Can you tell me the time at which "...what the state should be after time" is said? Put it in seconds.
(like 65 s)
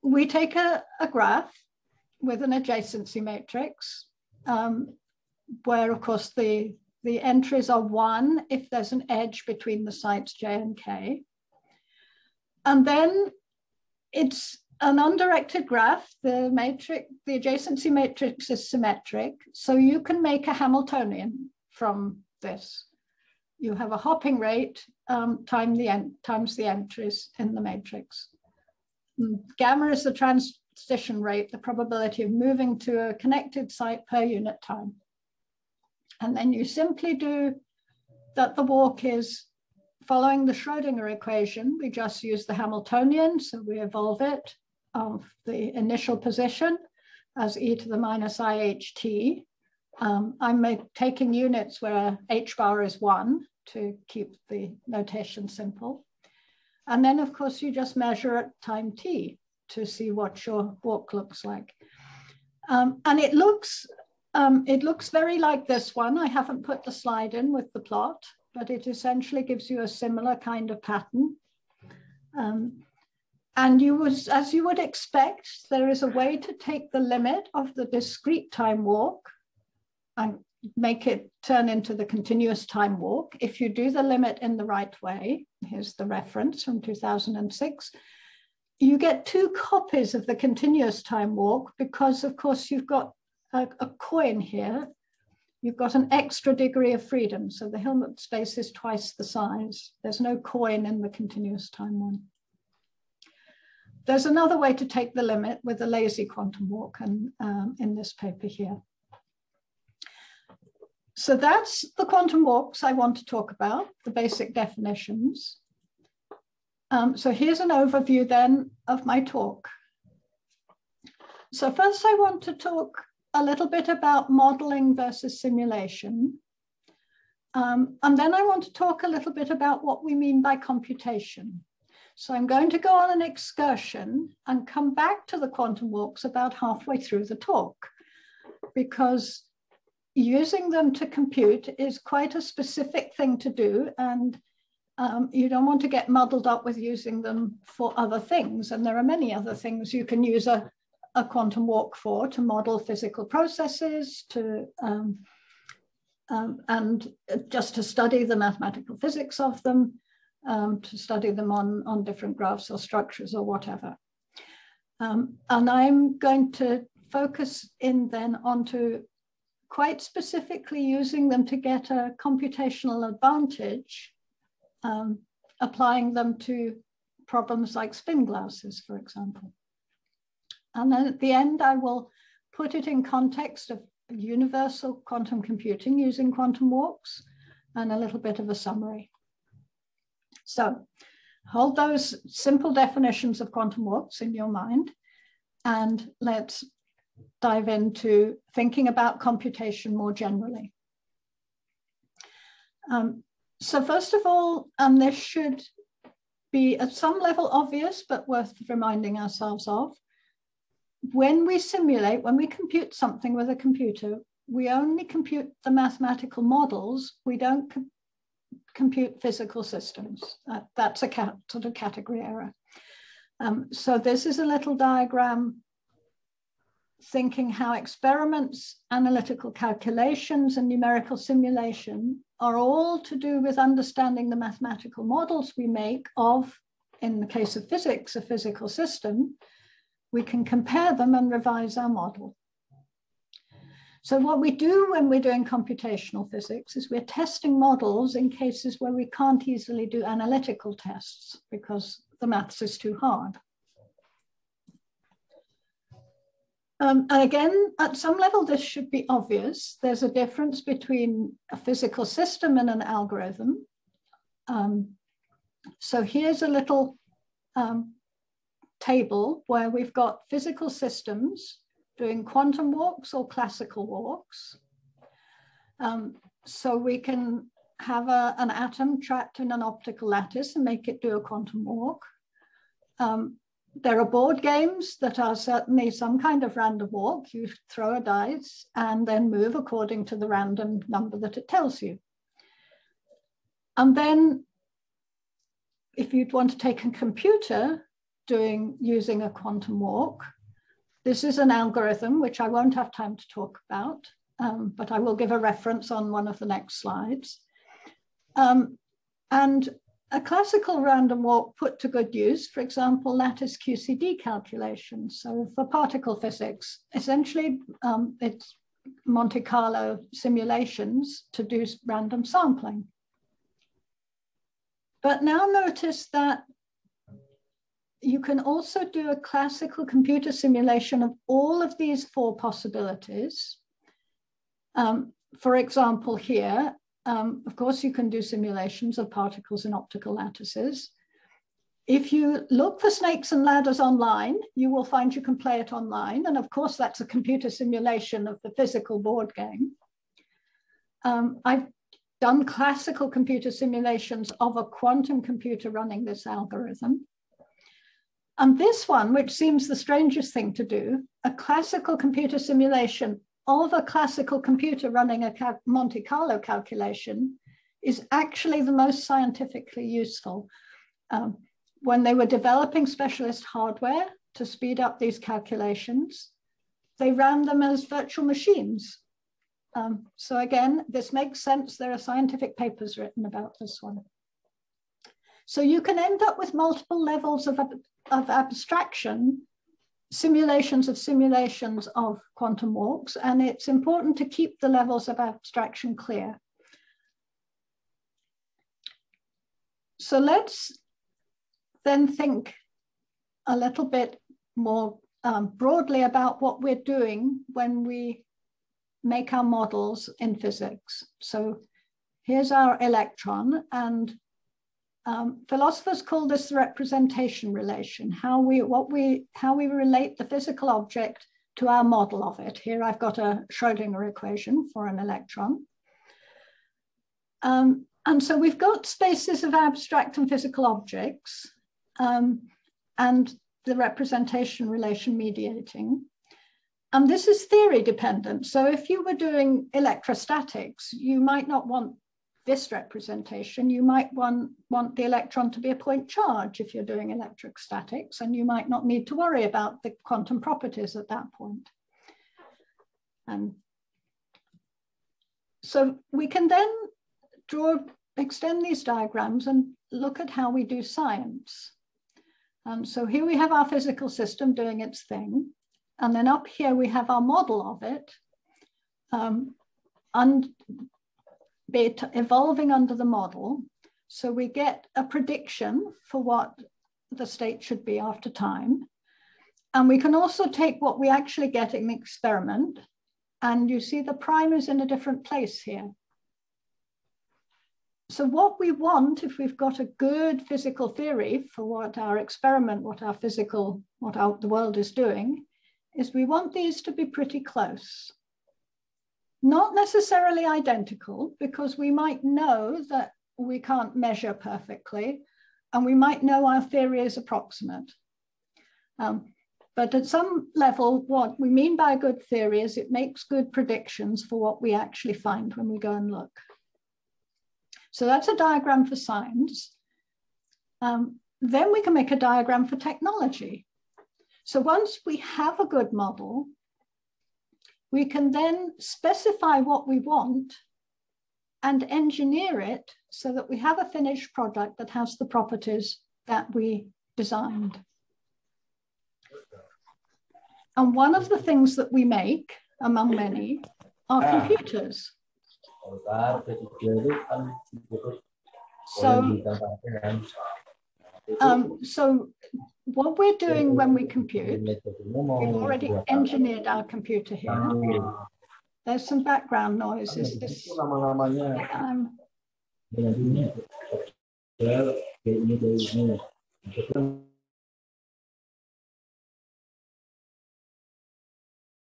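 476 s.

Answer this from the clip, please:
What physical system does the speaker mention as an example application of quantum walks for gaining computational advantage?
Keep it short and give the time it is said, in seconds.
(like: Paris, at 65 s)
spin glasses, at 177 s.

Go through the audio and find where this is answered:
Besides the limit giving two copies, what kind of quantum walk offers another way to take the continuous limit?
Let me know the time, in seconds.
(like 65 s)
105 s.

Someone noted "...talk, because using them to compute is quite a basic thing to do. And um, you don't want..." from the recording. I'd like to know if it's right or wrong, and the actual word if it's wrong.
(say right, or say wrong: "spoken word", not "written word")
wrong: "specific", not "basic".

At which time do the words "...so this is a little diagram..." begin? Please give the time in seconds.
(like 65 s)
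223 s.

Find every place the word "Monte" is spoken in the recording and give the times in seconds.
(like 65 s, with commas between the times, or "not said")
319 s, 365 s.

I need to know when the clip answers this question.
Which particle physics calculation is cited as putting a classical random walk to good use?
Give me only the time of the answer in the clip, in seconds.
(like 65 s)
313 s.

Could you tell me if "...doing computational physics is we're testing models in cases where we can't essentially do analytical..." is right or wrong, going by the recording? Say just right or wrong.
wrong.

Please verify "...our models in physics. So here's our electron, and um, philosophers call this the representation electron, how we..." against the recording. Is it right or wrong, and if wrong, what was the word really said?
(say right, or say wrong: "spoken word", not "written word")
wrong: "relation", not "electron".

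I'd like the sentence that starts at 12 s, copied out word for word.
And then it's an undirected graph, the matrix, the adjacency matrix is symmetric.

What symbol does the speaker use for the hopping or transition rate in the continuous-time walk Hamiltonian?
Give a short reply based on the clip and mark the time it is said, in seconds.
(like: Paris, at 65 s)
gamma, at 29 s.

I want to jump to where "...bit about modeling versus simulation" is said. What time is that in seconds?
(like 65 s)
123 s.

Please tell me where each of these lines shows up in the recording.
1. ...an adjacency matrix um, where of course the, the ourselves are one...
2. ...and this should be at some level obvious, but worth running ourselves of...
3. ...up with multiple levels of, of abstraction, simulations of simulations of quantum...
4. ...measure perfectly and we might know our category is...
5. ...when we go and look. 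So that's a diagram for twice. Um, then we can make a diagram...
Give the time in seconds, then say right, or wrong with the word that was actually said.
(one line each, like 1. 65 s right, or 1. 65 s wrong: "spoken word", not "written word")
1. 2 s wrong: "entries", not "ourselves"
2. 204 s wrong: "reminding", not "running"
3. 386 s right
4. 503 s wrong: "theory", not "category"
5. 515 s wrong: "science", not "twice".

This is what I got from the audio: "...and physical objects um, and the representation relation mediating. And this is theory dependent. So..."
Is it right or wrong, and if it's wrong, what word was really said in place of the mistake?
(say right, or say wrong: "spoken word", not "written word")
right.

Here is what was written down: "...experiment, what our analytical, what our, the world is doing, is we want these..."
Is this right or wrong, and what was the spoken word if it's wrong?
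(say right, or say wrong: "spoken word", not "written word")
wrong: "physical", not "analytical".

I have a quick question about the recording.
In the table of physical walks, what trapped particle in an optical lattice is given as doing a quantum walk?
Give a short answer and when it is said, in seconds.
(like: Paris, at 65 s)
an atom, at 278 s.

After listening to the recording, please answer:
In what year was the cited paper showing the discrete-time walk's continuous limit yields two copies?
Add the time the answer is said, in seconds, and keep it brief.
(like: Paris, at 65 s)
2006, at 86 s.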